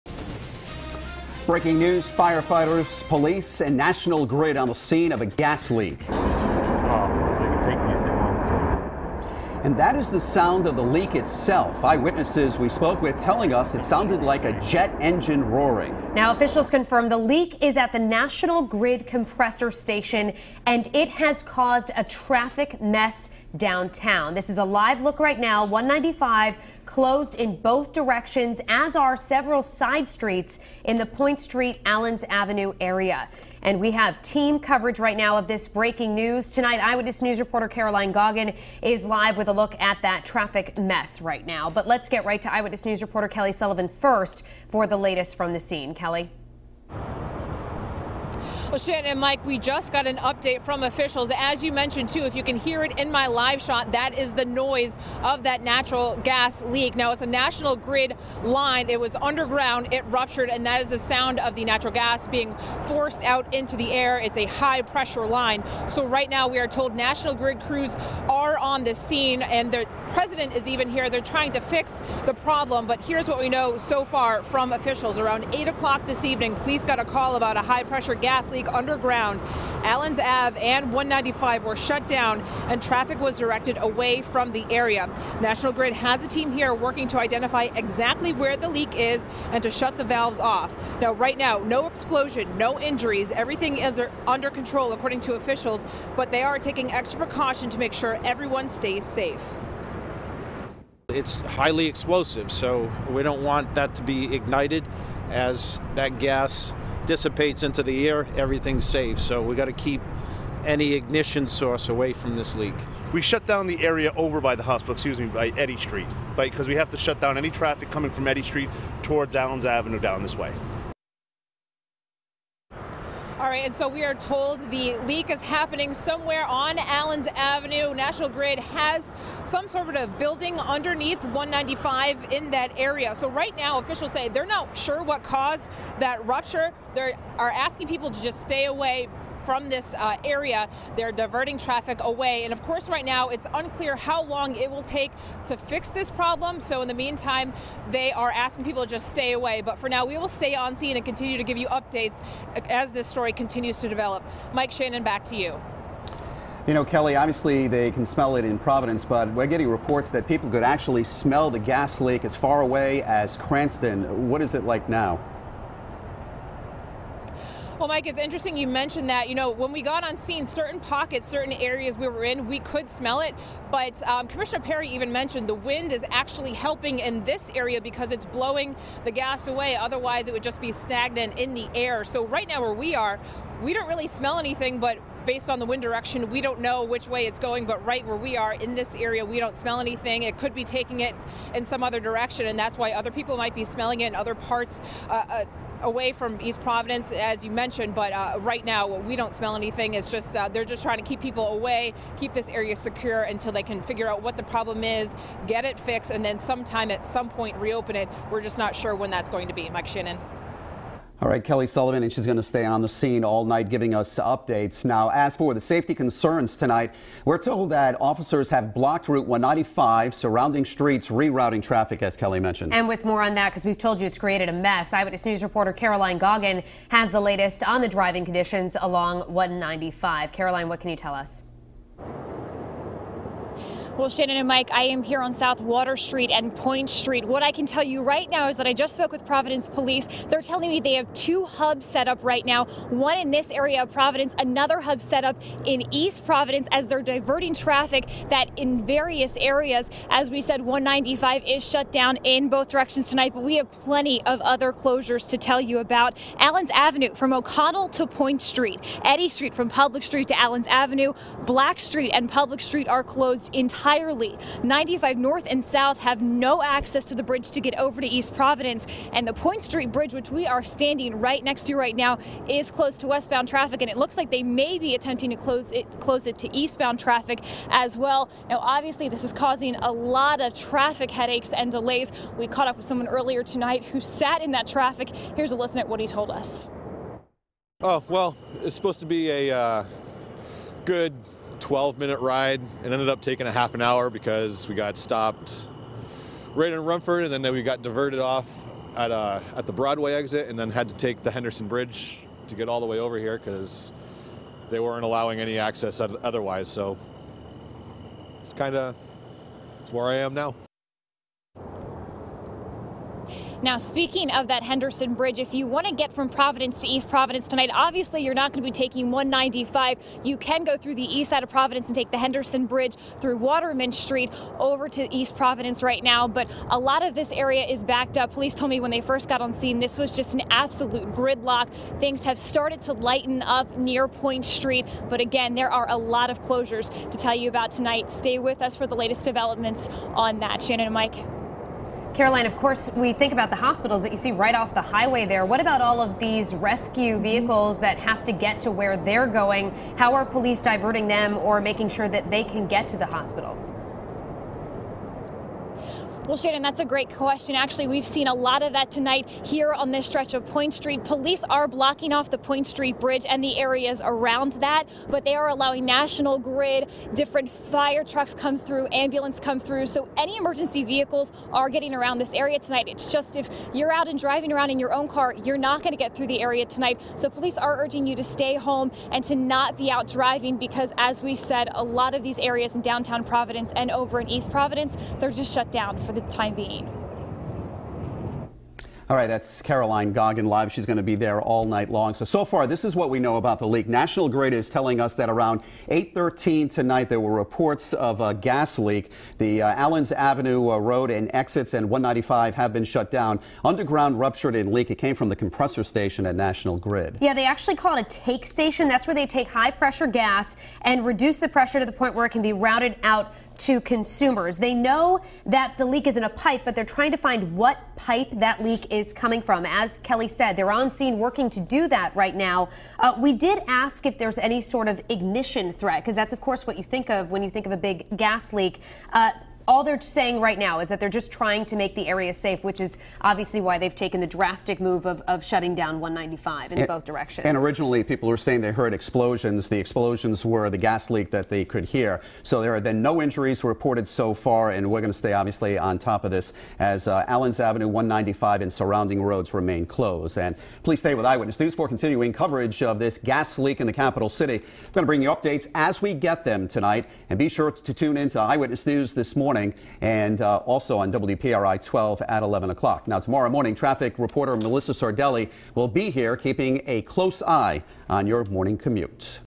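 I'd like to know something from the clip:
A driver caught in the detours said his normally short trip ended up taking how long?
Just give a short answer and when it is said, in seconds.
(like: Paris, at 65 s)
Half an hour, at 293 s.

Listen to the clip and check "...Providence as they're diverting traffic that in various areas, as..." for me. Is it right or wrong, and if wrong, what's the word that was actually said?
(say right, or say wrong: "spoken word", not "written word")
right.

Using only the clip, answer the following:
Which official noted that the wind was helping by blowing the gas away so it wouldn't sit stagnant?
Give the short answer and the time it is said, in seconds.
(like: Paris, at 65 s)
Commissioner Pare, at 174 s.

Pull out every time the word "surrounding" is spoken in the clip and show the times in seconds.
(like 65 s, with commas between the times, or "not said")
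220 s, 448 s.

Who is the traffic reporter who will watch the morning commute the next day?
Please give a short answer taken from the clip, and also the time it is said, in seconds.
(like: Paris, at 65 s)
Melissa Sardelli, at 464 s.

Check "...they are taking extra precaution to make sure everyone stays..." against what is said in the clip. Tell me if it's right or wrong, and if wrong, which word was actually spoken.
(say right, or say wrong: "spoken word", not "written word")
right.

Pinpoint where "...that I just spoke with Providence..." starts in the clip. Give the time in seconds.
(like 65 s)
238 s.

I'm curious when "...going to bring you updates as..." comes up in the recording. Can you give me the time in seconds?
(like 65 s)
454 s.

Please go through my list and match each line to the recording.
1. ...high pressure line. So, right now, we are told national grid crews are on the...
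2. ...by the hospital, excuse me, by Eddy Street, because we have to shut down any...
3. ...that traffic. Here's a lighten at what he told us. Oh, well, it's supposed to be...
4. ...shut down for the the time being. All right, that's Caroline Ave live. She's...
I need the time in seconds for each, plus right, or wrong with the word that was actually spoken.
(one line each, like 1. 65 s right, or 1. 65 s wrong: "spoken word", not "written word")
1. 64 s right
2. 114 s right
3. 284 s wrong: "listen", not "lighten"
4. 385 s wrong: "Goggin", not "Ave".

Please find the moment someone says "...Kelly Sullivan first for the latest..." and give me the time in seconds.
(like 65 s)
43 s.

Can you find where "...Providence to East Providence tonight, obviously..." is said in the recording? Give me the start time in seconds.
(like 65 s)
316 s.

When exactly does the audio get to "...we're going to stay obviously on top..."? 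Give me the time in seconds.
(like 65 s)
444 s.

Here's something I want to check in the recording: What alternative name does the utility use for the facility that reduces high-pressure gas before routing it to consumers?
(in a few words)
Take station.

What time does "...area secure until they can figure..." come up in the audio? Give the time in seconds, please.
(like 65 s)
202 s.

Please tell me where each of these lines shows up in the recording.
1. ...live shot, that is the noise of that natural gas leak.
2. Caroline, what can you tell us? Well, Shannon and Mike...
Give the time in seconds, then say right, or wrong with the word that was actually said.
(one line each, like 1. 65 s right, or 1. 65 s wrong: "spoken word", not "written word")
1. 53 s right
2. 230 s right.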